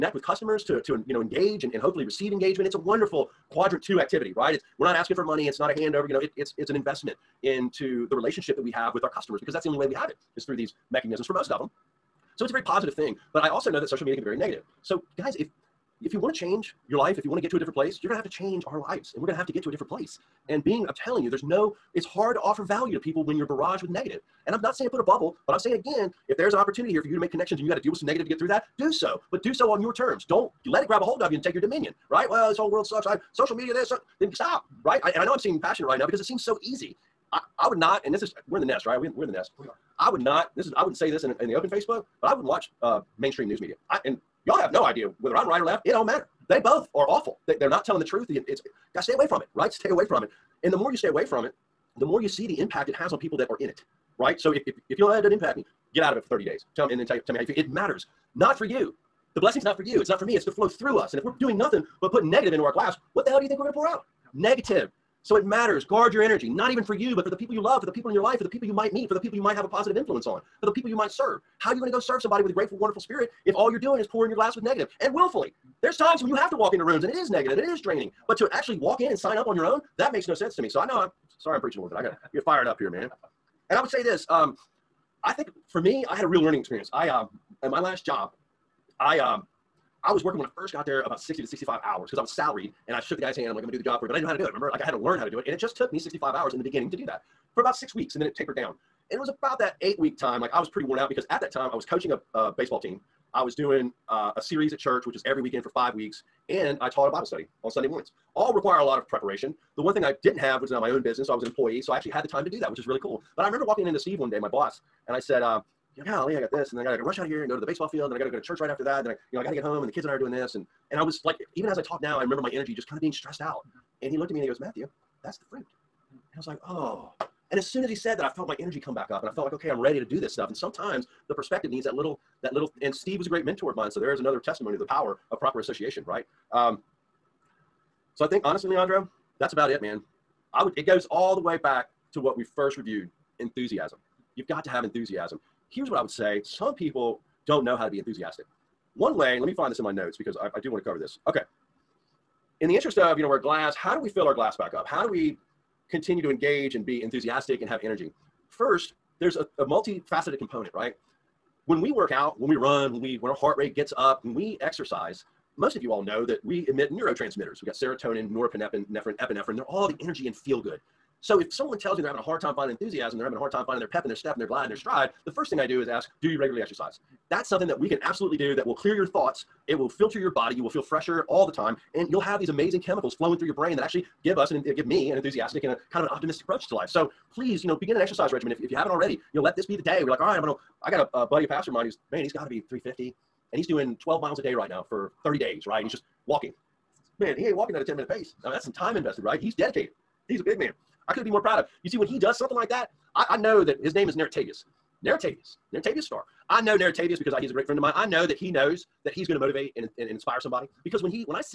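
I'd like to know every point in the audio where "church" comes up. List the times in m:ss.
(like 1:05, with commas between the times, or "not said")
1:44, 1:58.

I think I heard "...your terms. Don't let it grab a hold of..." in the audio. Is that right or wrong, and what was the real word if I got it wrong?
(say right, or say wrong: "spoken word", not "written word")
right.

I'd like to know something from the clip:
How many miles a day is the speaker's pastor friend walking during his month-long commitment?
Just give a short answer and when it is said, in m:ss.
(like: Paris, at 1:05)
12, at 3:13.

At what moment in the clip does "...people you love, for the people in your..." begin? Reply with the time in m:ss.
1:07.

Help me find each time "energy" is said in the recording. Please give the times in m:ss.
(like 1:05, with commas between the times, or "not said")
1:06, 2:02, 2:08, 2:37, 2:49.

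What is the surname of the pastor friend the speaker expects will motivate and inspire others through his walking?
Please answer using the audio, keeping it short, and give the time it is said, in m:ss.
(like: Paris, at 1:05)
Stark, at 3:26.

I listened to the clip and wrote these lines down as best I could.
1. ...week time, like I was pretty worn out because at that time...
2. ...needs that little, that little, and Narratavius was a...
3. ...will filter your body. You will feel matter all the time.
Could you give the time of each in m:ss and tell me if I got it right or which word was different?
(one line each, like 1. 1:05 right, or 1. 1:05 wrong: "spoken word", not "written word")
1. 1:39 right
2. 2:11 wrong: "Steve", not "Narratavius"
3. 2:59 wrong: "fresher", not "matter".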